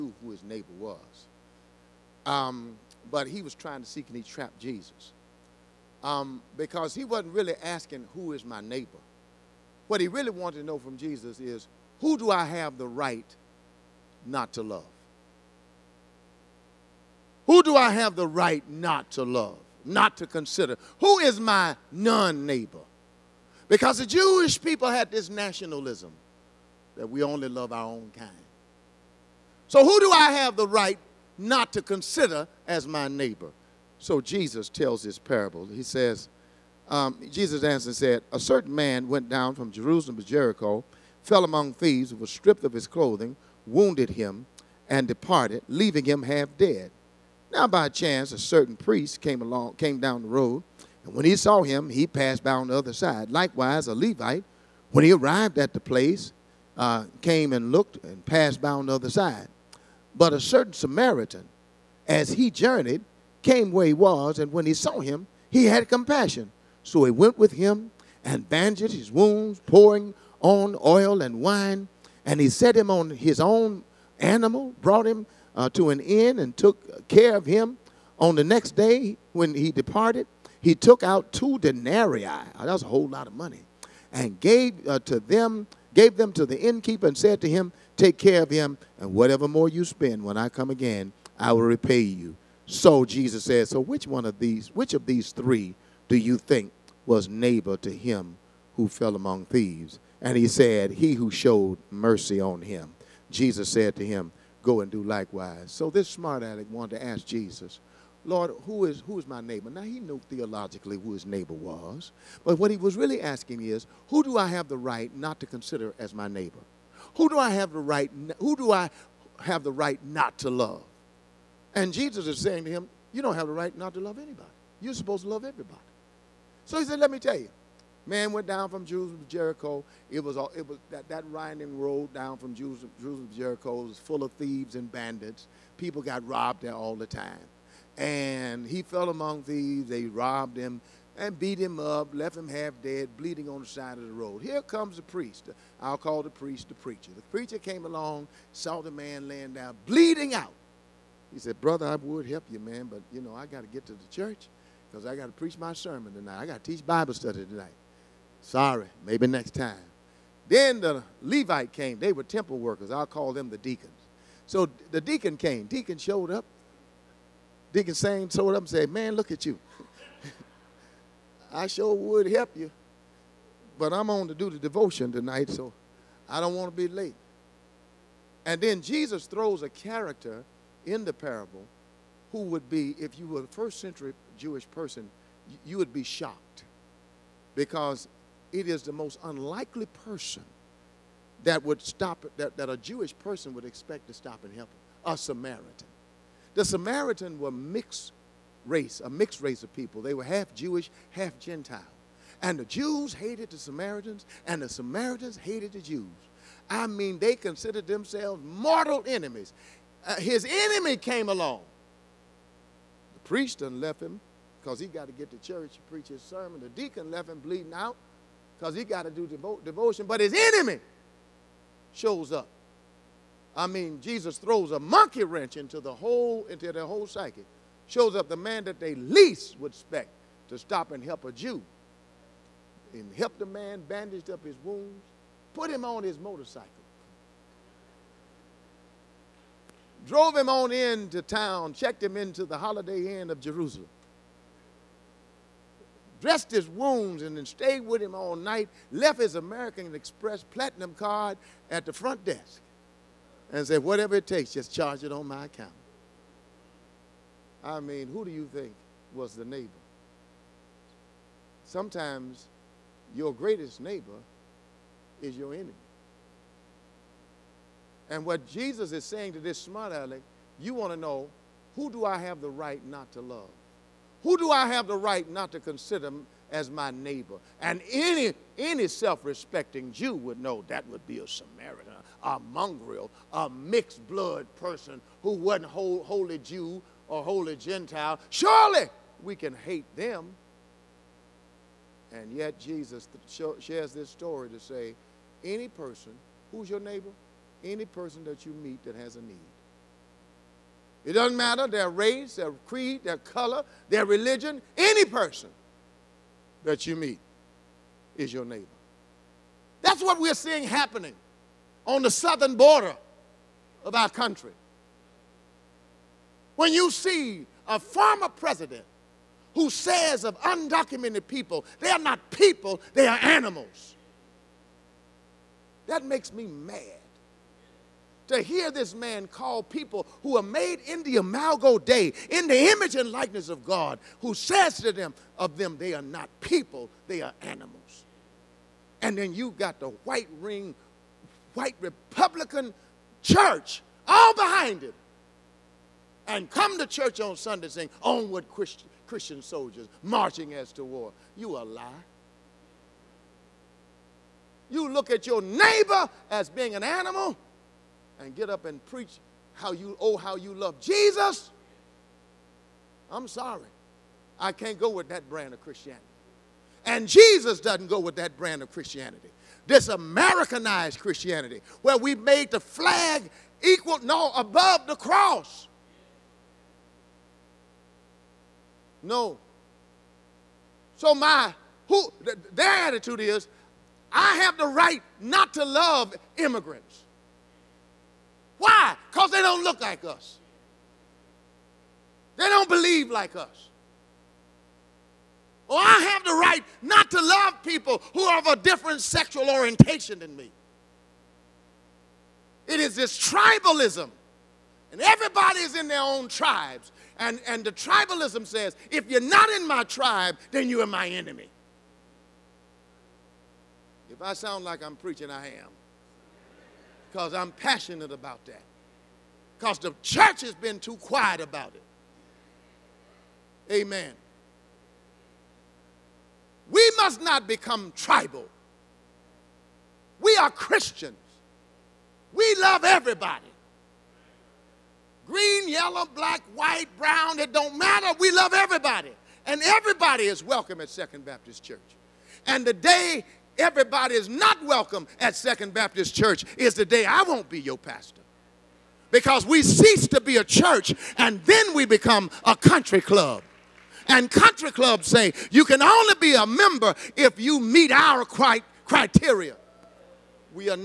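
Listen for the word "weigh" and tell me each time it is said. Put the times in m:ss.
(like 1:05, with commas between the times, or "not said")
not said.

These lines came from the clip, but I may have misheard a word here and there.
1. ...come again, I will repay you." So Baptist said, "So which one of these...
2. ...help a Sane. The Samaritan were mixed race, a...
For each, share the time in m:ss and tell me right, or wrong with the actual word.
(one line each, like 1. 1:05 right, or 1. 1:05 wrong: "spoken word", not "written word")
1. 1:30 wrong: "Jesus", not "Baptist"
2. 3:14 wrong: "Samaritan", not "Sane".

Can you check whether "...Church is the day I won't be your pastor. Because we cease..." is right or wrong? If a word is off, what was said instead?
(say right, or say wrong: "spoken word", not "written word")
right.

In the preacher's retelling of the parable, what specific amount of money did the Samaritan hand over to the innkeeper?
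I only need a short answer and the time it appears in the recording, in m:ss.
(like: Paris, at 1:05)
2 denarii, at 1:21.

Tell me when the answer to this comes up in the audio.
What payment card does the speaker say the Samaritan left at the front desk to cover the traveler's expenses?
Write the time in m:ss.
4:09.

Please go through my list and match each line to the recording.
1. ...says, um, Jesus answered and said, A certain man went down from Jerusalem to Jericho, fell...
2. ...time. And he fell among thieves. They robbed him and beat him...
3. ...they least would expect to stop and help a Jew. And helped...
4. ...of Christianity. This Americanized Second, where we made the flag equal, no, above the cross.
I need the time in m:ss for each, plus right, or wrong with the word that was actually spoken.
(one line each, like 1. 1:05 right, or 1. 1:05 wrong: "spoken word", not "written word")
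1. 0:35 right
2. 2:17 right
3. 3:48 right
4. 6:08 wrong: "Christianity", not "Second".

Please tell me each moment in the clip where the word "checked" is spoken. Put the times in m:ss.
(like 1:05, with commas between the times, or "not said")
4:01.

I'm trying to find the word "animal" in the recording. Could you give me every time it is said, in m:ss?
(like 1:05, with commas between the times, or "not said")
1:14, 5:23, 5:37, 5:56.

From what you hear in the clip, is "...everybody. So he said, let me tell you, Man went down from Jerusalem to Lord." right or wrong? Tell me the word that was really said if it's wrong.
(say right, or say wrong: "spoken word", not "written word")
wrong: "Jericho", not "Lord".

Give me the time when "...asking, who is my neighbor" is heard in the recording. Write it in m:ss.
0:07.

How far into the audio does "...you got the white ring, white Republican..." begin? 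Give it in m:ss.
5:39.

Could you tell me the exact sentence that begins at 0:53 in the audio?
Likewise, a Levite, when he arrived at the place, uh, came and looked and passed by on the other side.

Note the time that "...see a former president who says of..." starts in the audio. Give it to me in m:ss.
5:16.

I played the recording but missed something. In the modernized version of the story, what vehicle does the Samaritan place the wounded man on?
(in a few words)
motorcycle.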